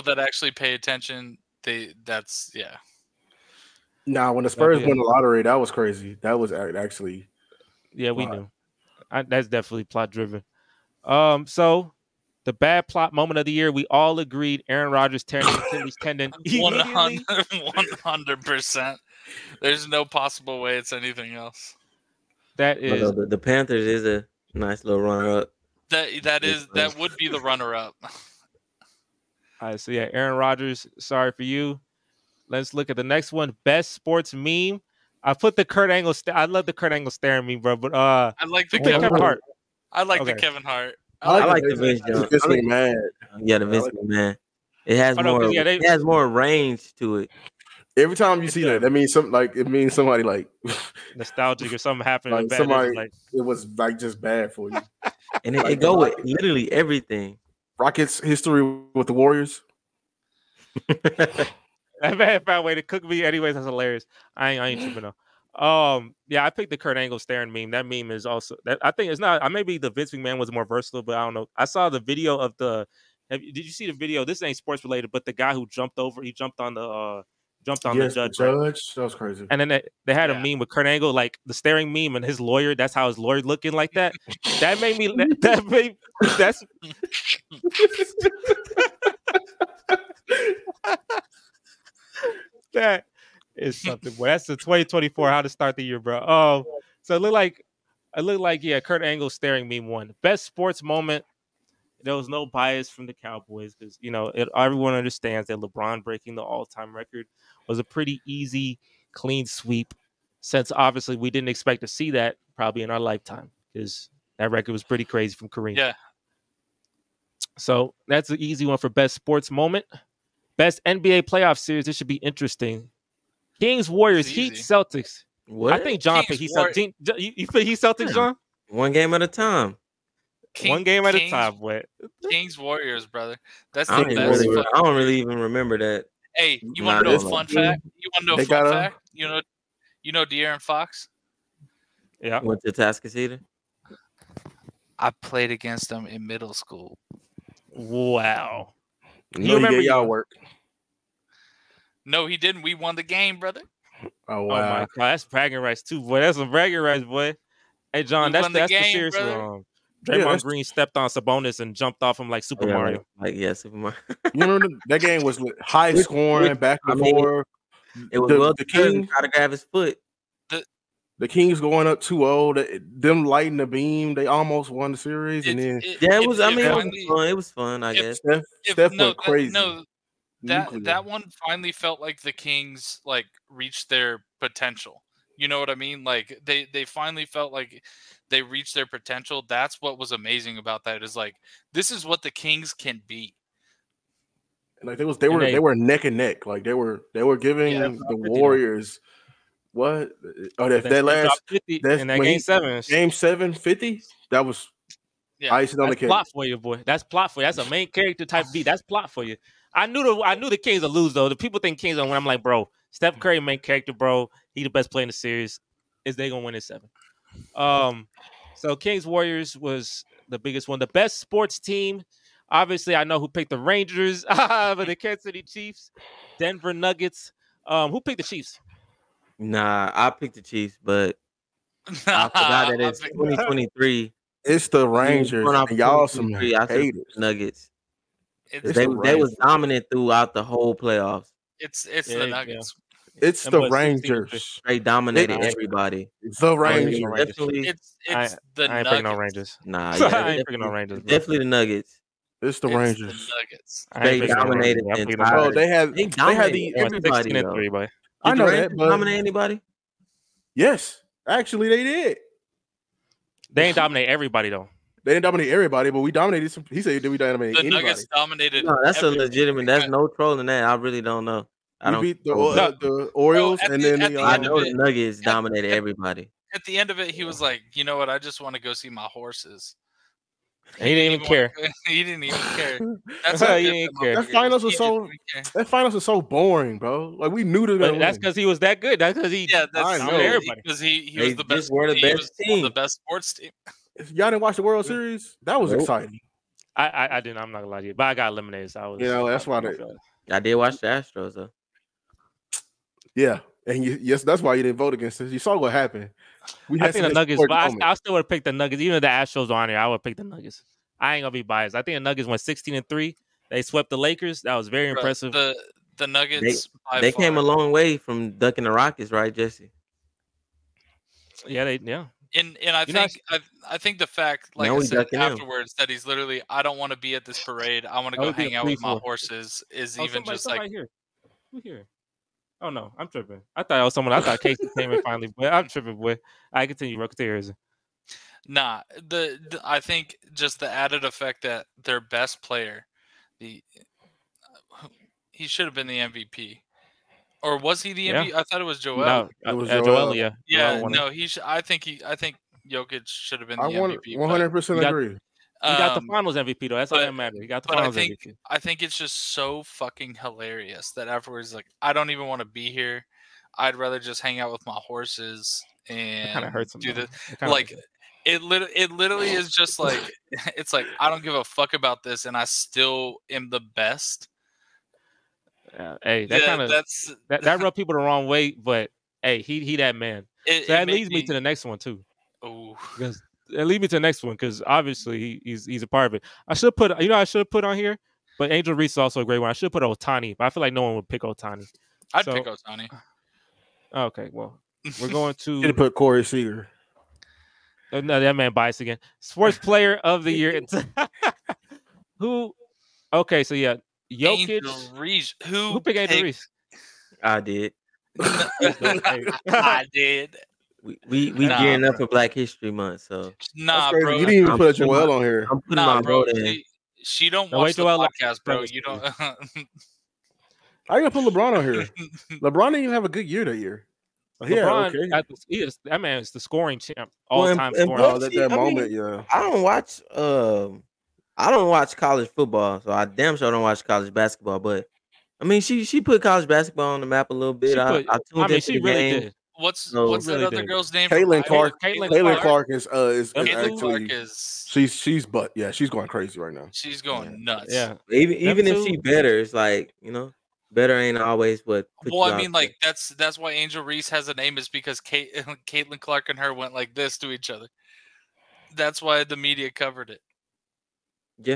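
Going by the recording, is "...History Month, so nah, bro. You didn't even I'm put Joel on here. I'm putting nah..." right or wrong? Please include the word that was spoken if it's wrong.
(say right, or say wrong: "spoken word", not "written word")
right.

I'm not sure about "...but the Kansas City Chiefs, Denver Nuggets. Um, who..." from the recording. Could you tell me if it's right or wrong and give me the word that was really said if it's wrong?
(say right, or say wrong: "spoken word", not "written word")
right.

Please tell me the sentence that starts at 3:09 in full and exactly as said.
That's what was amazing about that is like this is what the Kings can be.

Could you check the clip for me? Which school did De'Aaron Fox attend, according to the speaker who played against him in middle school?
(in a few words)
Tascadero.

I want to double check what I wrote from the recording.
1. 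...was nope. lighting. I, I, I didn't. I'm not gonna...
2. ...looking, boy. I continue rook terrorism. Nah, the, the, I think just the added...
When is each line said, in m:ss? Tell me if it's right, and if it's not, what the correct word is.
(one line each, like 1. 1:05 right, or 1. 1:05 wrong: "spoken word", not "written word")
1. 4:55 wrong: "exciting", not "lighting"
2. 5:35 wrong: "tripping", not "looking".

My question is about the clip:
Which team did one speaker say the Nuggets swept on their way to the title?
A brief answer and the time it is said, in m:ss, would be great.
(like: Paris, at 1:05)
the Lakers, at 5:13.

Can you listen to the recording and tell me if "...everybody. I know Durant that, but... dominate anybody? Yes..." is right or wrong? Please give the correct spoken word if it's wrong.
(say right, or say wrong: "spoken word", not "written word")
right.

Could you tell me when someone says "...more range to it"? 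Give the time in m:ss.
0:46.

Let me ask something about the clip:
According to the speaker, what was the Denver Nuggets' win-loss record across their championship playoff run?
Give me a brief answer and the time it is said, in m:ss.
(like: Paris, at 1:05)
16 and 3, at 5:12.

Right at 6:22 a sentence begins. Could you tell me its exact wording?
Oh, because and leave me to the next one because obviously he's he's a part of it.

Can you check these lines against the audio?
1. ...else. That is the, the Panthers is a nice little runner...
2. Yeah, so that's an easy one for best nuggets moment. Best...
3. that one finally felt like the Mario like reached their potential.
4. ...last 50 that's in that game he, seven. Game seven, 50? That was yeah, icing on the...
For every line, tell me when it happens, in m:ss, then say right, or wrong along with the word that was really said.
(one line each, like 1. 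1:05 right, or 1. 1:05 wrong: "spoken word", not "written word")
1. 0:21 right
2. 1:55 wrong: "sports", not "nuggets"
3. 3:00 wrong: "Kings", not "Mario"
4. 3:21 right.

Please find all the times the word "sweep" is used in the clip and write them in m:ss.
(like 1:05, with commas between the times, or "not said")
1:49.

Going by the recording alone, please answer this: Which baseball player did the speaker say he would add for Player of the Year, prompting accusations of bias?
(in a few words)
Corey Seager.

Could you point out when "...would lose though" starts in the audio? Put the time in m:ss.
3:30.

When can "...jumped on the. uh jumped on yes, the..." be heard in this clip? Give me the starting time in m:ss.
1:16.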